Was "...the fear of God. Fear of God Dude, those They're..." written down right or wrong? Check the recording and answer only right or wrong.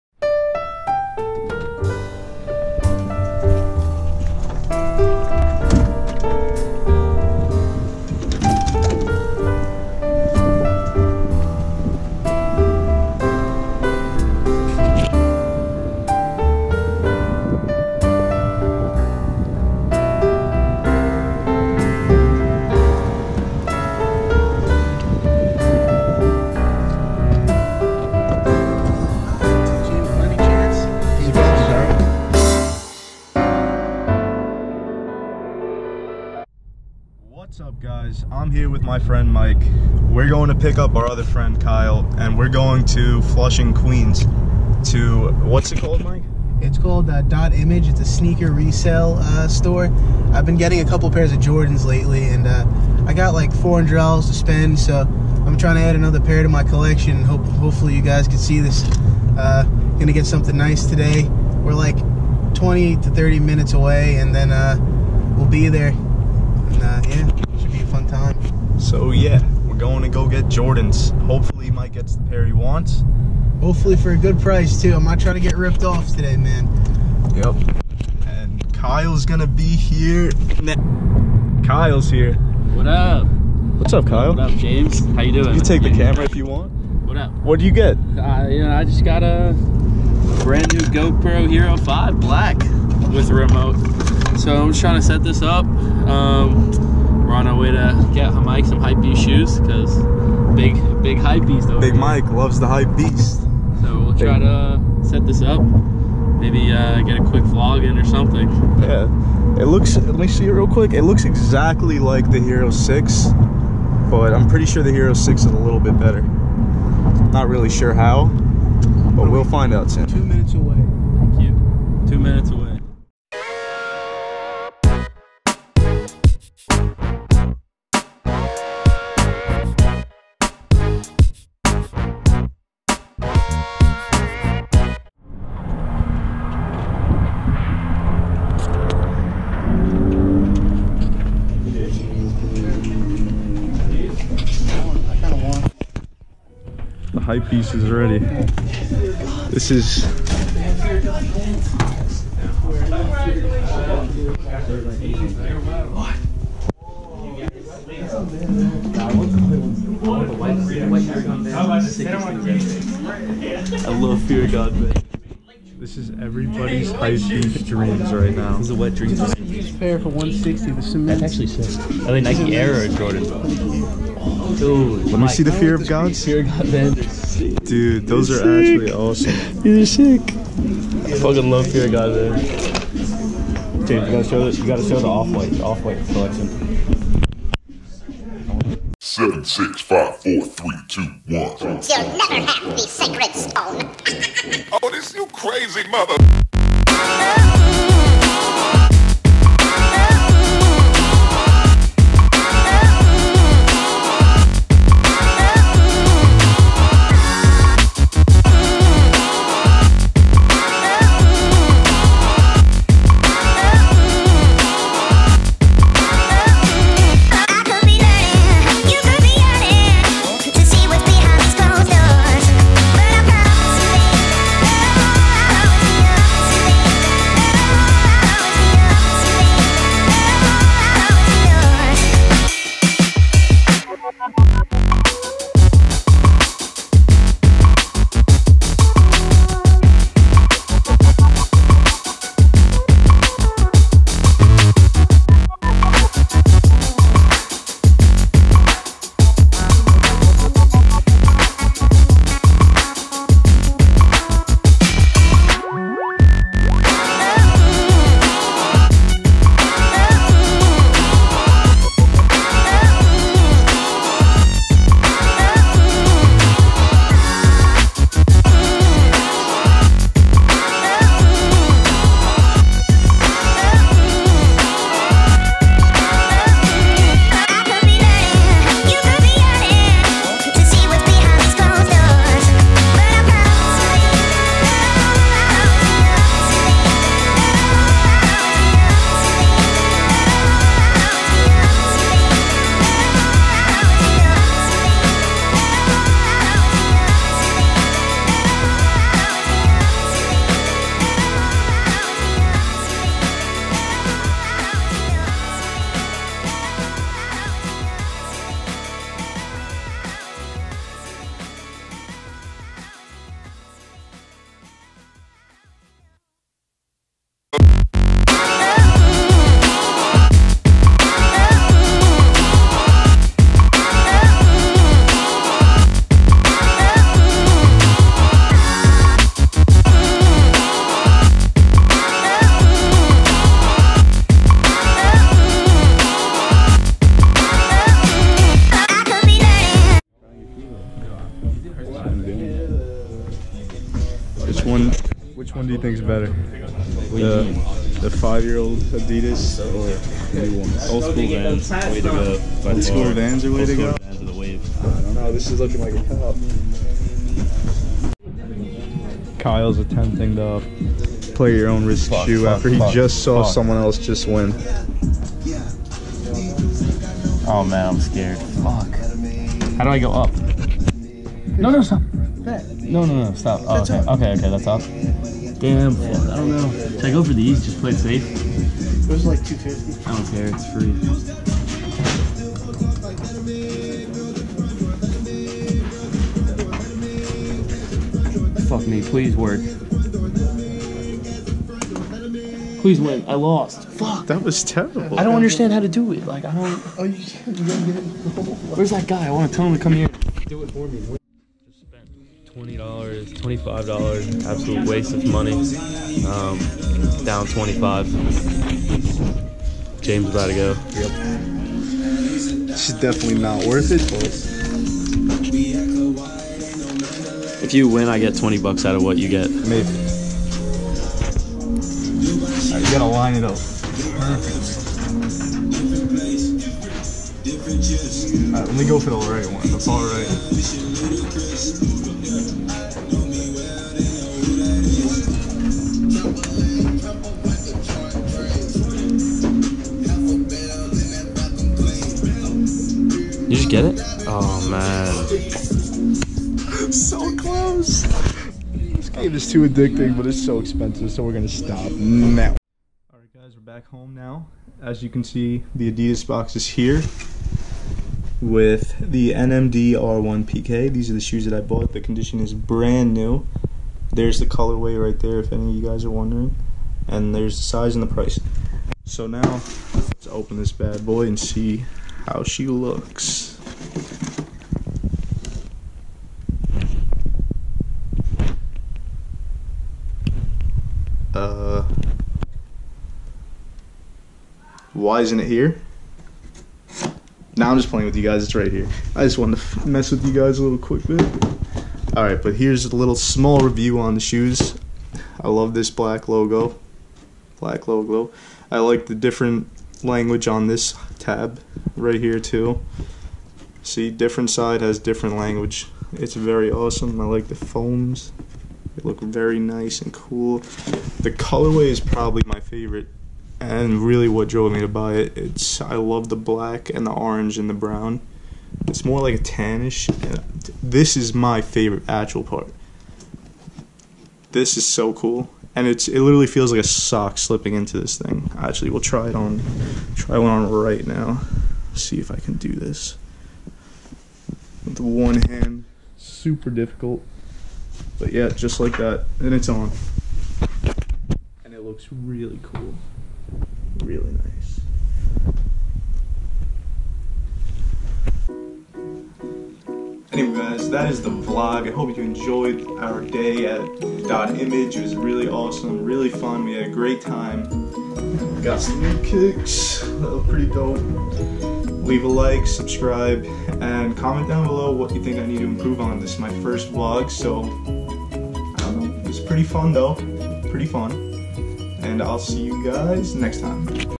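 right.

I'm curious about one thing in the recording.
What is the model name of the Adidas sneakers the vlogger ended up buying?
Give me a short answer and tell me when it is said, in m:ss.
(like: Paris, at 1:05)
NMD R1 PK, at 7:39.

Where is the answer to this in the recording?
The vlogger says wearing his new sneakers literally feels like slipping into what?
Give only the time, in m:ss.
8:46.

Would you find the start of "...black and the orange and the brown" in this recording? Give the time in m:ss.
8:36.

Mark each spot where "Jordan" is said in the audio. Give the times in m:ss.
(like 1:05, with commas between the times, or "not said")
0:51, 1:10, 2:52.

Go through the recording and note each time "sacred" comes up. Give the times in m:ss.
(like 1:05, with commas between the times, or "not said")
3:12.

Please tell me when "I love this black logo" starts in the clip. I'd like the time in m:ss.
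8:15.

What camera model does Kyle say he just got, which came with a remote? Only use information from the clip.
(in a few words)
GoPro Hero 5 Black.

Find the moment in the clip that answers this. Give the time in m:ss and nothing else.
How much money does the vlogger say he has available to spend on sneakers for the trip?
0:53.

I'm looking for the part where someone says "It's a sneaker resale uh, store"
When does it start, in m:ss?
0:47.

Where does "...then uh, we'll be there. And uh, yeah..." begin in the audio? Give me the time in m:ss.
1:04.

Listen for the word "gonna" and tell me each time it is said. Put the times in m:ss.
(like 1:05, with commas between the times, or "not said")
0:59, 1:19, 7:31.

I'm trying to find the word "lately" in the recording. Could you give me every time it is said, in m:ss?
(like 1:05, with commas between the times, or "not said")
0:51.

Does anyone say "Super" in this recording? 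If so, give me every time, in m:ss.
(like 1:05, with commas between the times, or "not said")
8:56.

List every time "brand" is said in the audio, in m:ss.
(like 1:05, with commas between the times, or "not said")
1:30, 7:42.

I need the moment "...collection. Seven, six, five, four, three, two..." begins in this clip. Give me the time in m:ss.
3:06.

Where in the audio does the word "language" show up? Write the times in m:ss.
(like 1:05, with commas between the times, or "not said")
8:20, 8:25.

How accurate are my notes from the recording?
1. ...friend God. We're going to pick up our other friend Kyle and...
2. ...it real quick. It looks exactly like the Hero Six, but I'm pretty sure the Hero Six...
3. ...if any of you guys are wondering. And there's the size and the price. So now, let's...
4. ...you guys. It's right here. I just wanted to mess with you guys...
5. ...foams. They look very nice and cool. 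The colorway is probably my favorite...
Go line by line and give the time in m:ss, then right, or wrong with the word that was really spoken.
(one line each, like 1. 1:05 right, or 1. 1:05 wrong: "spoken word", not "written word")
1. 0:38 wrong: "Mike", not "God"
2. 1:50 right
3. 7:45 right
4. 8:08 right
5. 8:27 right.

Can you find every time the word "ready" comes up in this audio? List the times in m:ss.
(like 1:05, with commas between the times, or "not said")
2:27.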